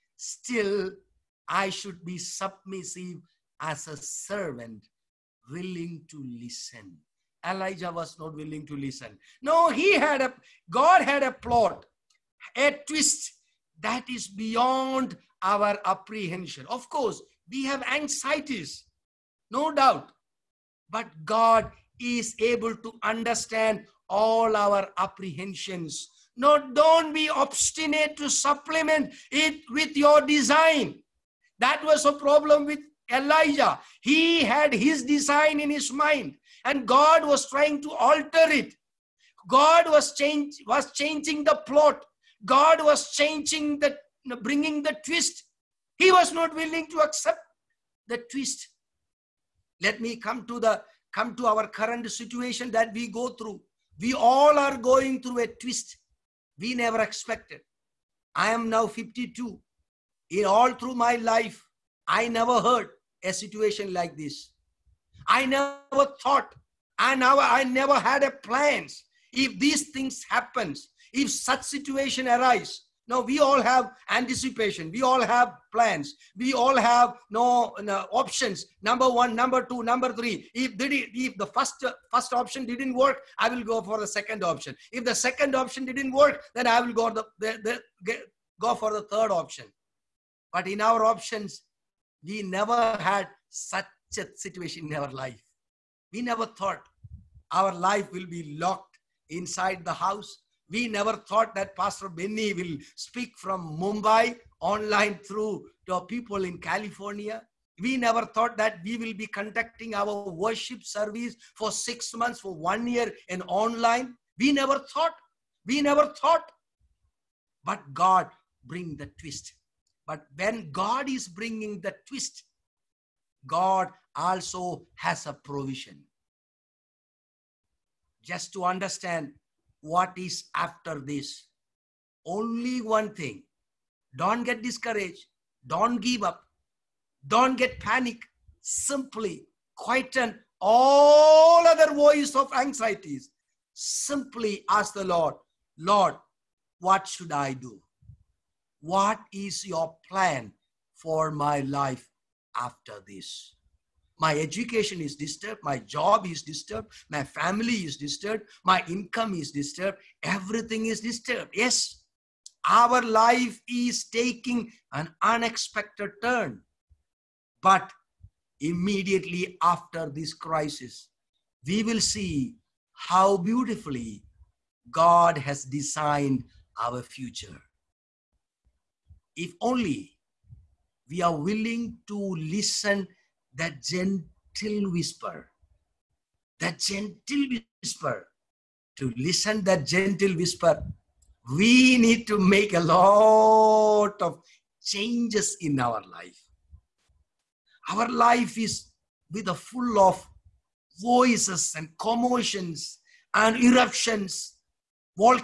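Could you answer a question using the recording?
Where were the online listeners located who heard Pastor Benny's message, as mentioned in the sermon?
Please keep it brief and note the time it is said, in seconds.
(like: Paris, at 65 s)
California, at 106 s.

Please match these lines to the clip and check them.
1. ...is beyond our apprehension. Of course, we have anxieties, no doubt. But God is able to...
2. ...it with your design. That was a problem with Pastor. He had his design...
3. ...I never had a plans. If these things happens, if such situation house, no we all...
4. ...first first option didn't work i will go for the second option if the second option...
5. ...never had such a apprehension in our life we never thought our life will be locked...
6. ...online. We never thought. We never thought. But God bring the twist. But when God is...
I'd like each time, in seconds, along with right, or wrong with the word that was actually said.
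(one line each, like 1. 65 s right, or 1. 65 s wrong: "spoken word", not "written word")
1. 14 s right
2. 29 s wrong: "Elijah", not "Pastor"
3. 67 s wrong: "arise", not "house"
4. 81 s right
5. 92 s wrong: "situation", not "apprehension"
6. 113 s right.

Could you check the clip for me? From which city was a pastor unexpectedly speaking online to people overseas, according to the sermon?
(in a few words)
Mumbai.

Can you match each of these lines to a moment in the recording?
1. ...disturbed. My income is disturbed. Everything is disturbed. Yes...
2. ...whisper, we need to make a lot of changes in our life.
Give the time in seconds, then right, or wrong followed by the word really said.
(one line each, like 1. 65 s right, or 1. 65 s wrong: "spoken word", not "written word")
1. 157 s right
2. 190 s right.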